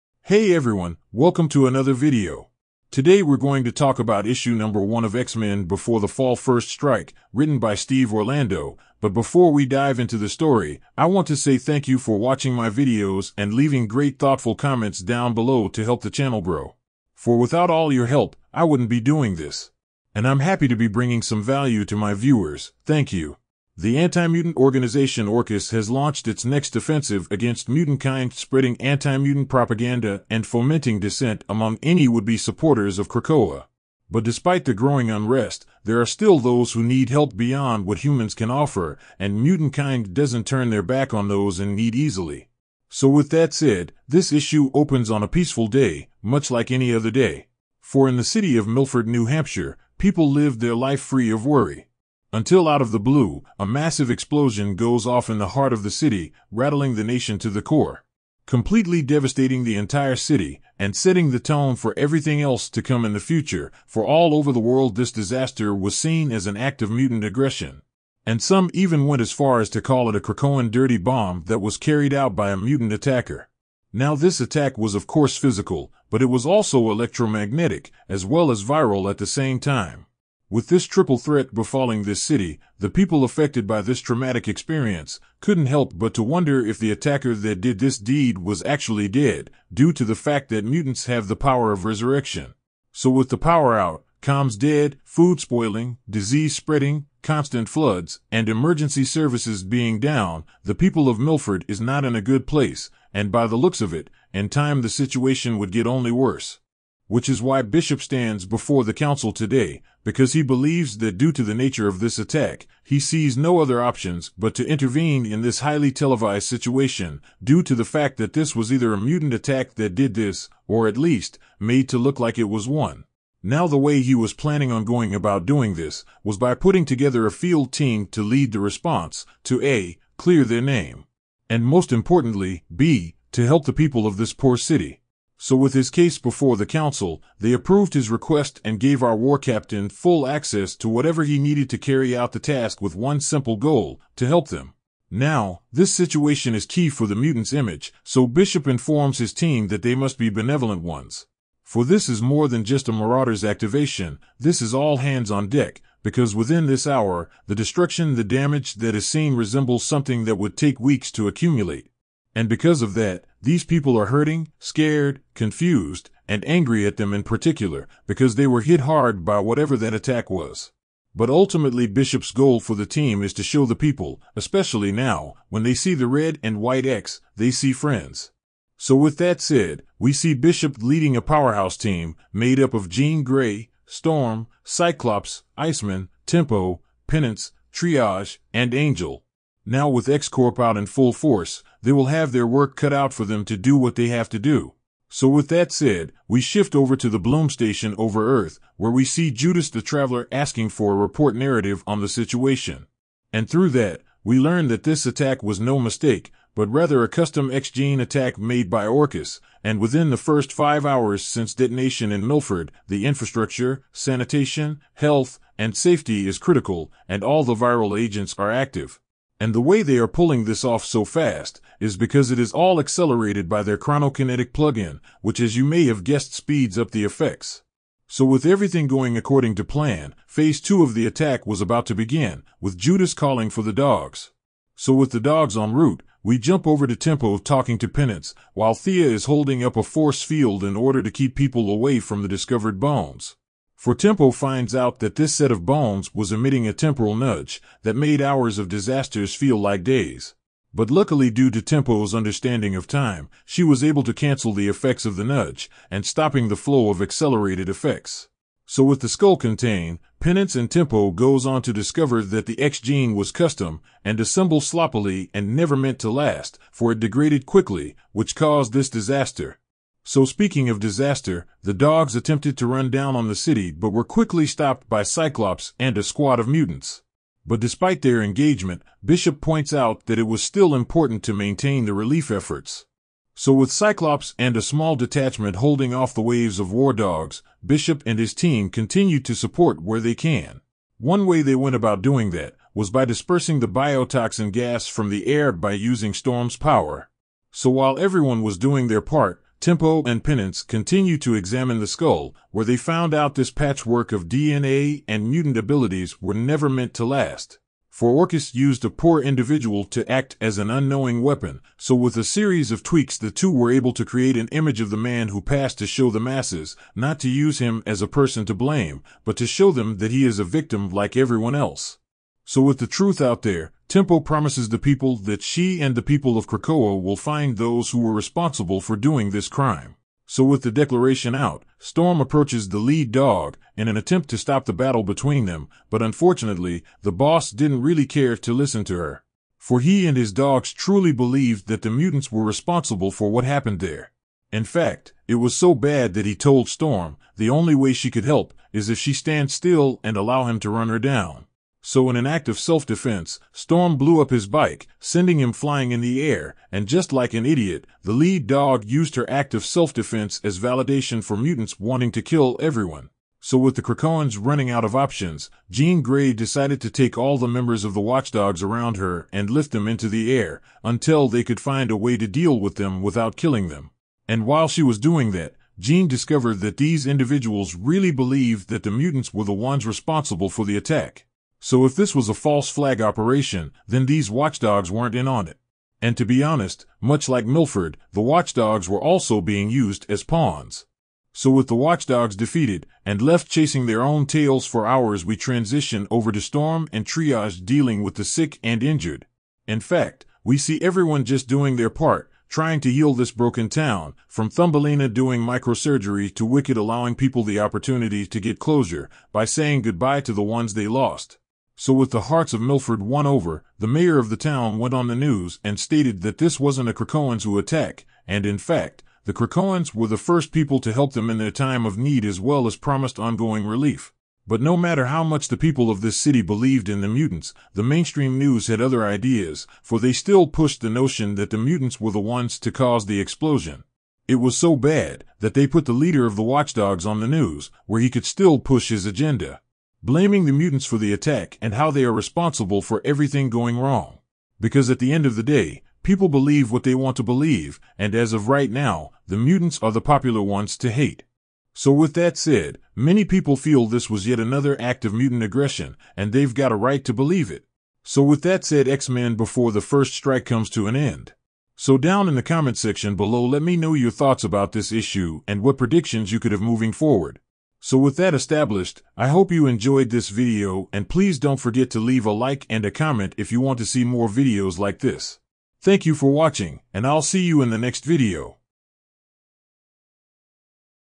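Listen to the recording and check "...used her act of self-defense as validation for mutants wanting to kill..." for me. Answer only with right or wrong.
right.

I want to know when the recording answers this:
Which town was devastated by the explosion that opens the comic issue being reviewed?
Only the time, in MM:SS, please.
00:48.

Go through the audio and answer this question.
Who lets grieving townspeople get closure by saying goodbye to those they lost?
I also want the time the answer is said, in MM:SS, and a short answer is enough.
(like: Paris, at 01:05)
Wicked, at 06:46.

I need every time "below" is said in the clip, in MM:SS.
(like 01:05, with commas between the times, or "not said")
00:15, 07:43.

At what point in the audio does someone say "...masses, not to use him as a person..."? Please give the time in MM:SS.
05:16.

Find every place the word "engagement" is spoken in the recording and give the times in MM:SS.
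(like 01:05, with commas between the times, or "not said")
04:38.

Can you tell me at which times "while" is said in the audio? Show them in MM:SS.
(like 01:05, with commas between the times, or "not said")
03:58, 04:57, 06:14.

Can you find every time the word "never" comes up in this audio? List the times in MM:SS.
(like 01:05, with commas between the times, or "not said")
04:25, 05:06.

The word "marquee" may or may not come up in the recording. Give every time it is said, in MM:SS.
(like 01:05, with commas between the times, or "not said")
not said.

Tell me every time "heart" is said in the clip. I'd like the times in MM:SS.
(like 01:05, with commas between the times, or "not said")
00:55, 06:52.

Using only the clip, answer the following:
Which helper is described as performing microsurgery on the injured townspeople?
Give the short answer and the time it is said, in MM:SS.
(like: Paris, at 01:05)
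Thumbelina, at 06:44.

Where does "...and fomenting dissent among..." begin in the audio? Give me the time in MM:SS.
00:30.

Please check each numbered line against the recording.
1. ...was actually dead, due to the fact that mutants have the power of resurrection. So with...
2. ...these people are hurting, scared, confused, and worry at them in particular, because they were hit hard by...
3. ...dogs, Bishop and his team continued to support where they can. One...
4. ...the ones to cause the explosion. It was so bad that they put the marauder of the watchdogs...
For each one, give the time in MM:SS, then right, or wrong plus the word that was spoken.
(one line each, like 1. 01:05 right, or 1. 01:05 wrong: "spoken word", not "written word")
1. 01:28 right
2. 02:43 wrong: "angry", not "worry"
3. 04:46 right
4. 07:12 wrong: "leader", not "marauder".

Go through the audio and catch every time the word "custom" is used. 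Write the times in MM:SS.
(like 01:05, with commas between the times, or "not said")
03:27, 04:23.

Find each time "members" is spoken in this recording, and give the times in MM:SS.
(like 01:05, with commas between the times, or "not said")
06:07.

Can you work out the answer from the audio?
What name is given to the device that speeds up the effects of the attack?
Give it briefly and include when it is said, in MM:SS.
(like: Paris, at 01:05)
chronokinetic plug-in, at 03:43.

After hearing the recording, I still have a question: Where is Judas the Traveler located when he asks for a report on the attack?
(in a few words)
Bloom Station.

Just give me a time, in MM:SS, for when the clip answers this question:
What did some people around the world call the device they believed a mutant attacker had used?
01:10.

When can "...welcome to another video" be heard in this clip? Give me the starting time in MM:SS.
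00:01.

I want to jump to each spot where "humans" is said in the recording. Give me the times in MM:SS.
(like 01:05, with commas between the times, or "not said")
00:37.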